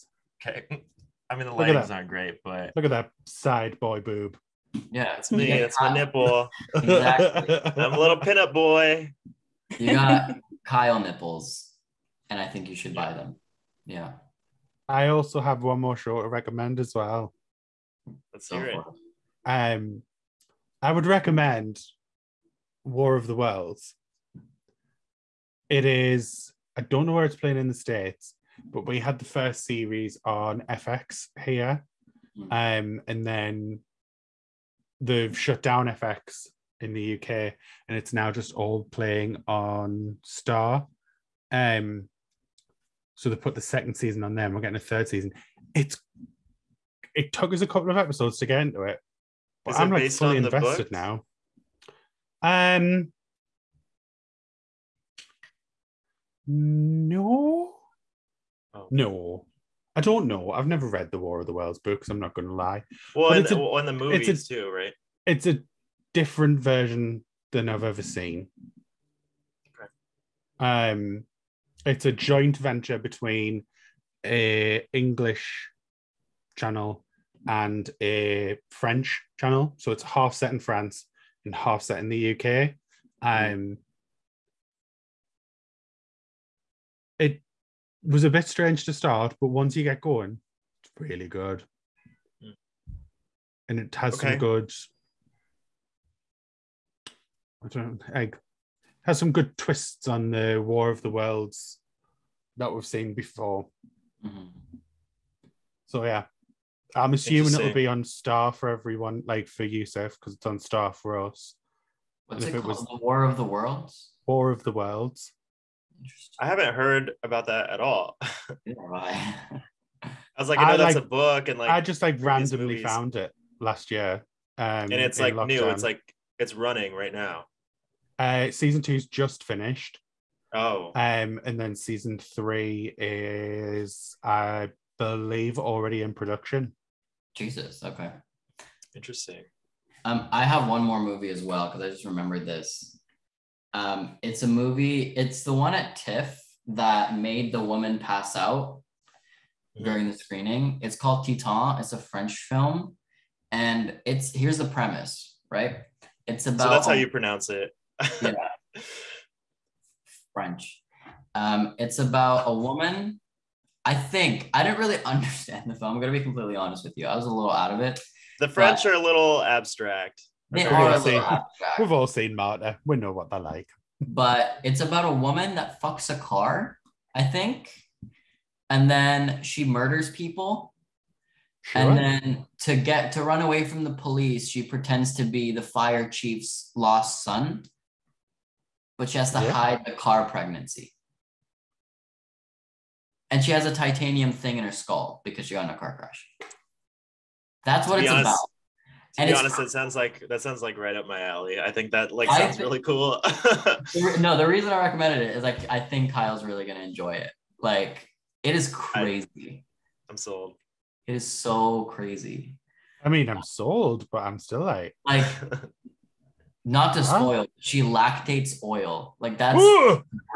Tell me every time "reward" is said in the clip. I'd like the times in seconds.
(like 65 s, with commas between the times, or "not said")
not said.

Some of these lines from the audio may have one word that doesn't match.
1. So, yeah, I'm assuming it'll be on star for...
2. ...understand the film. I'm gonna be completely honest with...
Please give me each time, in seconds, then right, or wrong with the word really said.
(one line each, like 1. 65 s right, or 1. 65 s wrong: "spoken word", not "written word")
1. 105 s right
2. 165 s right.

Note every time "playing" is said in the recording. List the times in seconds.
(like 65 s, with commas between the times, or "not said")
27 s, 38 s.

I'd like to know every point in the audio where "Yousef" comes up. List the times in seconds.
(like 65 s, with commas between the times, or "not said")
109 s.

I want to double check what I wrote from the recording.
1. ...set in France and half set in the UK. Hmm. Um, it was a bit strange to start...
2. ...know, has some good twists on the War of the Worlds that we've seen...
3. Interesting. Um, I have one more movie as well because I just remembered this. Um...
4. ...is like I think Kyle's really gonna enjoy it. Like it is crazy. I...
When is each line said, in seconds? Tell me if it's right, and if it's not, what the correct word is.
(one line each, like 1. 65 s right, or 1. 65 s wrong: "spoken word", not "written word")
1. 80 s right
2. 98 s right
3. 138 s right
4. 205 s right.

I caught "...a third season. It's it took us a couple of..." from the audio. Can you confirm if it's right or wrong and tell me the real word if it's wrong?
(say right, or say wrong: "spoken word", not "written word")
right.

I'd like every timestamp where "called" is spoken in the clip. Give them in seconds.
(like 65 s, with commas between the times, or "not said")
112 s, 150 s.